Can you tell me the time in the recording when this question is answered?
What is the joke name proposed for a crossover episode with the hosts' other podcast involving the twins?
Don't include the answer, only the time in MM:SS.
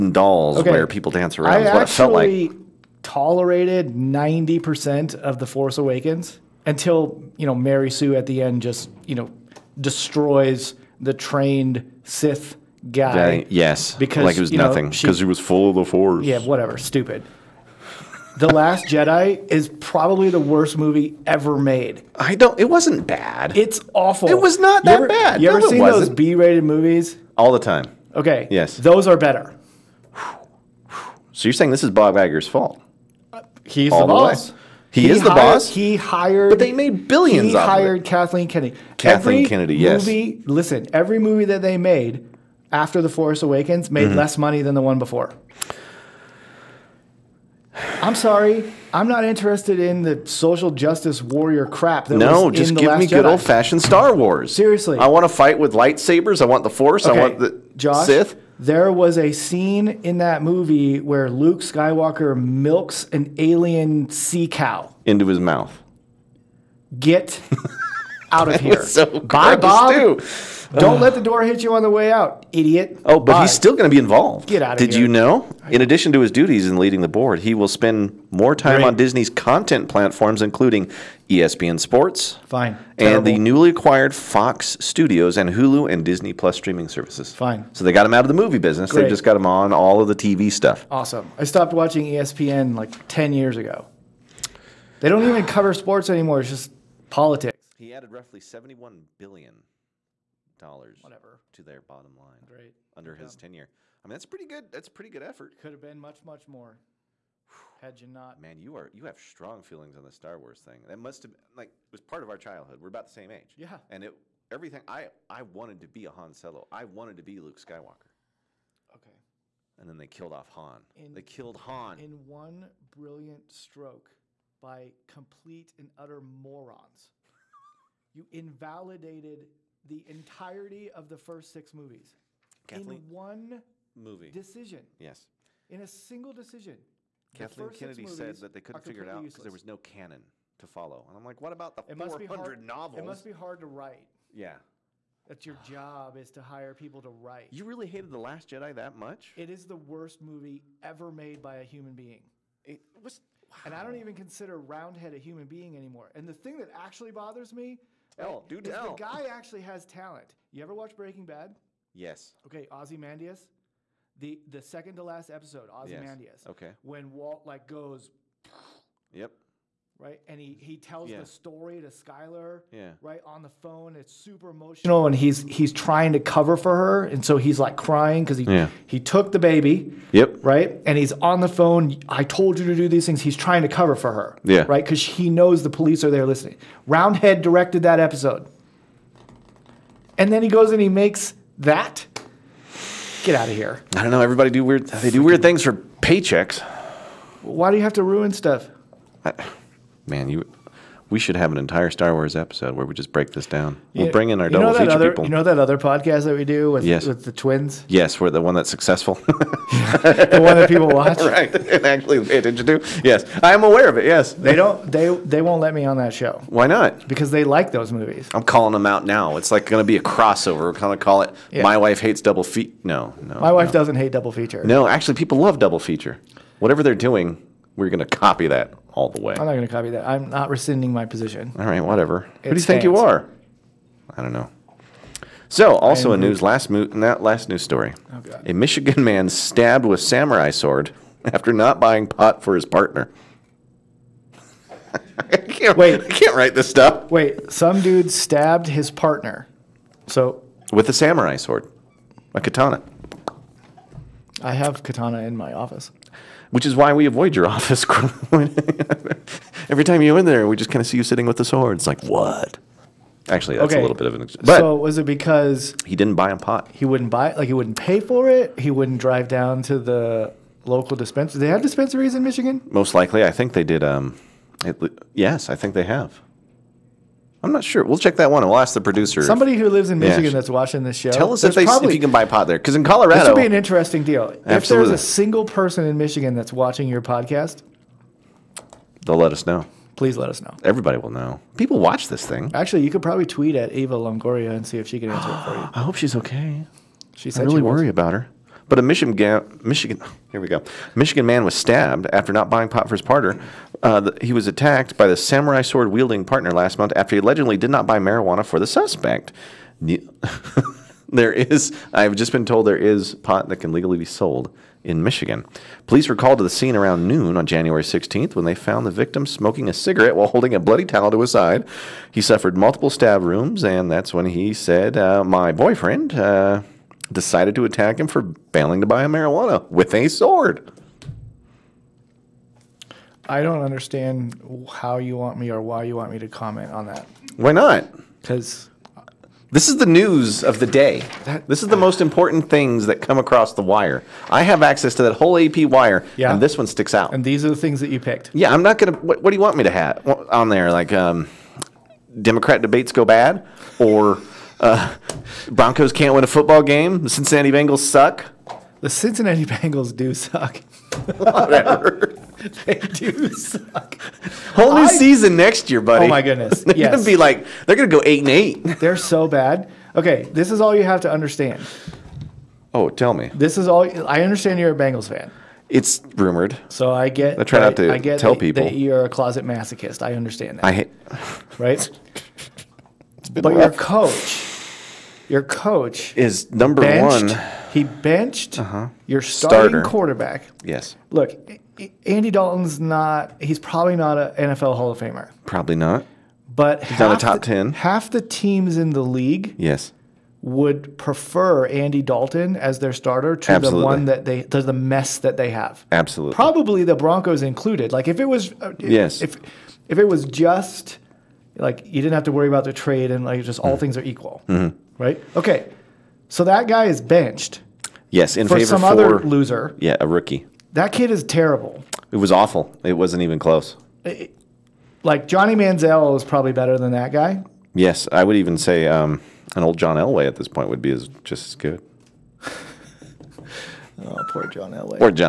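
03:41.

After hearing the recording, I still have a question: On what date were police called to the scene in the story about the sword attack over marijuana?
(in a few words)
January 16.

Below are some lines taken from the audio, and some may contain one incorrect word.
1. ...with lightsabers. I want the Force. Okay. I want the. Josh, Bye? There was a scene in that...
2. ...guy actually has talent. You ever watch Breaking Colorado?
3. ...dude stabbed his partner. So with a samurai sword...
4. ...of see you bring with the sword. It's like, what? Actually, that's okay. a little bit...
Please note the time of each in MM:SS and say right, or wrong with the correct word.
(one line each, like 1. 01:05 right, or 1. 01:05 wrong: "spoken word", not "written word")
1. 00:55 wrong: "Sith", not "Bye"
2. 02:38 wrong: "Bad", not "Colorado"
3. 04:07 right
4. 04:20 wrong: "sitting", not "bring".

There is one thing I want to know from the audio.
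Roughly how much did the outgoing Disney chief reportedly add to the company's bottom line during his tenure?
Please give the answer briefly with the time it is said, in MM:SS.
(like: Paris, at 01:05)
$71 billion, at 01:38.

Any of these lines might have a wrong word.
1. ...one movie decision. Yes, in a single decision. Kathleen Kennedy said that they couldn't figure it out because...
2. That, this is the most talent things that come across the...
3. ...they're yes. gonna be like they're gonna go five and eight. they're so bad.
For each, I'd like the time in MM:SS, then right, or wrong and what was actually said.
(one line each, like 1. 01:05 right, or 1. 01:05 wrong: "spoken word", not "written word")
1. 02:13 right
2. 05:41 wrong: "important", not "talent"
3. 06:06 wrong: "eight", not "five".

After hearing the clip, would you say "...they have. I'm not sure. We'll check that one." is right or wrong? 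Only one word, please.
right.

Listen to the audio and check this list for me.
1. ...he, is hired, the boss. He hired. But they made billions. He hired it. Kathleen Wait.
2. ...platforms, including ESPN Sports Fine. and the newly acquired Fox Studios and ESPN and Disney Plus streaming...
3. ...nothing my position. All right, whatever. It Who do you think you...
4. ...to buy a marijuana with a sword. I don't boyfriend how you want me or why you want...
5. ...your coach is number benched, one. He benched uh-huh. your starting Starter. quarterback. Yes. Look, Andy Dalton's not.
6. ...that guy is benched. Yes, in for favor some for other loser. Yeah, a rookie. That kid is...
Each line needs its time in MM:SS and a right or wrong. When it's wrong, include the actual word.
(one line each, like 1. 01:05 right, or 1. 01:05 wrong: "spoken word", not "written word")
1. 00:35 wrong: "Kennedy", not "Wait"
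2. 01:19 wrong: "Hulu", not "ESPN"
3. 03:50 wrong: "rescinding", not "nothing"
4. 05:28 wrong: "understand", not "boyfriend"
5. 06:25 right
6. 06:56 right.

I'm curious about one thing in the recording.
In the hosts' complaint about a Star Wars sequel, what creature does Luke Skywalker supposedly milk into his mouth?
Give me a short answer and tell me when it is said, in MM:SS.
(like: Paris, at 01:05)
alien sea cow, at 01:03.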